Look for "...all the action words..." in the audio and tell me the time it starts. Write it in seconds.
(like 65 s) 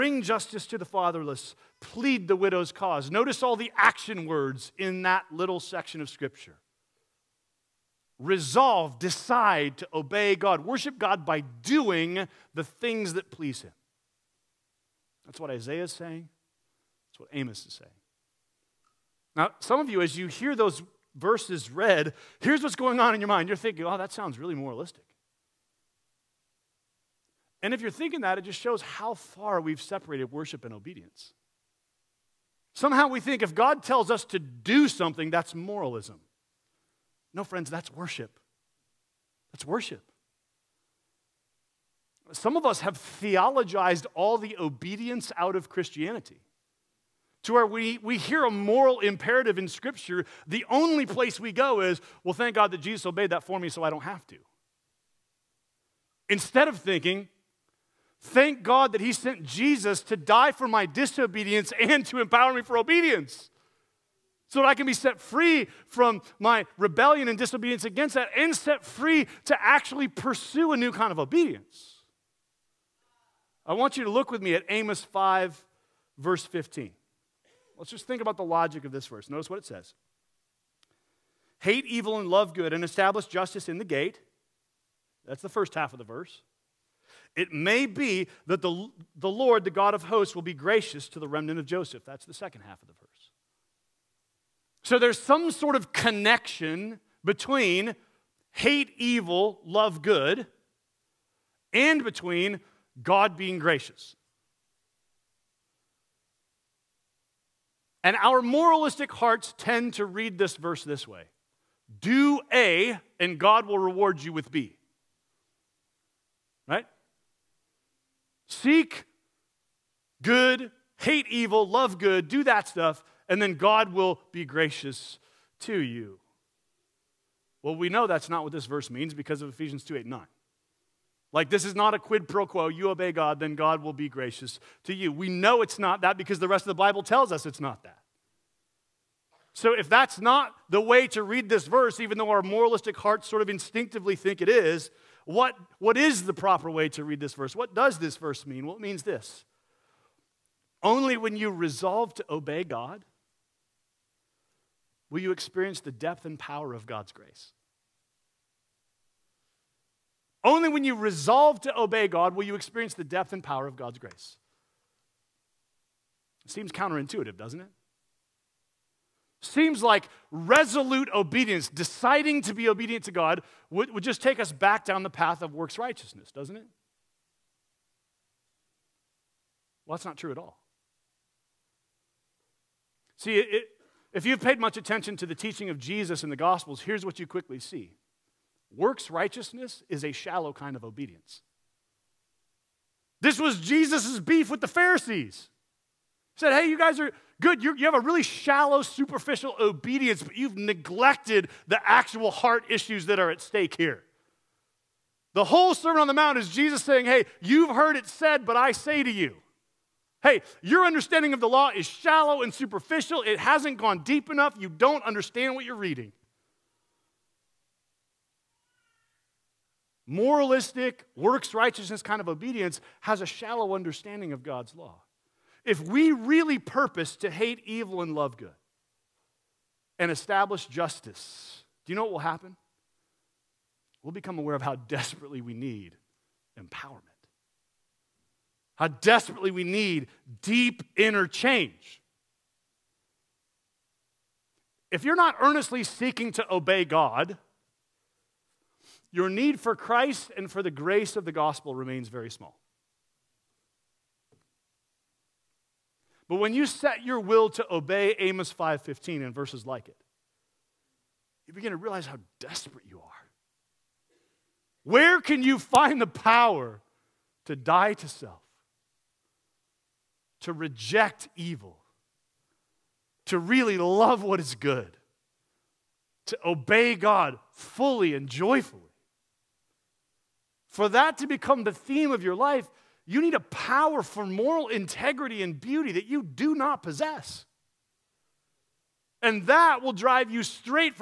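3 s.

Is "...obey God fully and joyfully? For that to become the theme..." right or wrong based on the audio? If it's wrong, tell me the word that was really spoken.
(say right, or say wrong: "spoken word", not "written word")
right.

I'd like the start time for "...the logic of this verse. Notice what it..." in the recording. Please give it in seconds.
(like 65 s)
78 s.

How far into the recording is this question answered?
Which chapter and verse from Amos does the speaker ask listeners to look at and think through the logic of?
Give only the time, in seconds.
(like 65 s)
74 s.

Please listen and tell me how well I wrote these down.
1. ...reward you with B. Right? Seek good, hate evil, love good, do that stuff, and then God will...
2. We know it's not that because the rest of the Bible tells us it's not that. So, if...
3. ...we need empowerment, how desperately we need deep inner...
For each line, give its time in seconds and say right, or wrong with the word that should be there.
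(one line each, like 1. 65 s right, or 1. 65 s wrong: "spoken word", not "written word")
1. 113 s right
2. 135 s right
3. 235 s right.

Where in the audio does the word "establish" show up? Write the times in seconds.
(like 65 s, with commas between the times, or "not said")
82 s, 230 s.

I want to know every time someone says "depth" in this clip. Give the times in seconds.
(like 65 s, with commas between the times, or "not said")
155 s, 163 s.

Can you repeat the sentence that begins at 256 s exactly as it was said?
But when you set your will to obey Amos 5:15 and verses like it, you begin to realize how desperate you are.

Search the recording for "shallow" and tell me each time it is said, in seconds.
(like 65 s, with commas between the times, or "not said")
190 s, 198 s, 211 s, 223 s.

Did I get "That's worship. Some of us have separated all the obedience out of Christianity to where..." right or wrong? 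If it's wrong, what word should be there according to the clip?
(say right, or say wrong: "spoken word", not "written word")
wrong: "theologized", not "separated".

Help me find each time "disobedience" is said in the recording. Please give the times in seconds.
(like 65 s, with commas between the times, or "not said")
60 s, 67 s.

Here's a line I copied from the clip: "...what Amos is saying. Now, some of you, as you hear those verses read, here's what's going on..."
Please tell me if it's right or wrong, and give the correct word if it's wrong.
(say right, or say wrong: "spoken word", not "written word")
right.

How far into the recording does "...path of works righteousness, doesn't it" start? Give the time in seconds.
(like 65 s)
175 s.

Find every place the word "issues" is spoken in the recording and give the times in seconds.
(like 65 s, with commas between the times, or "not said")
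202 s.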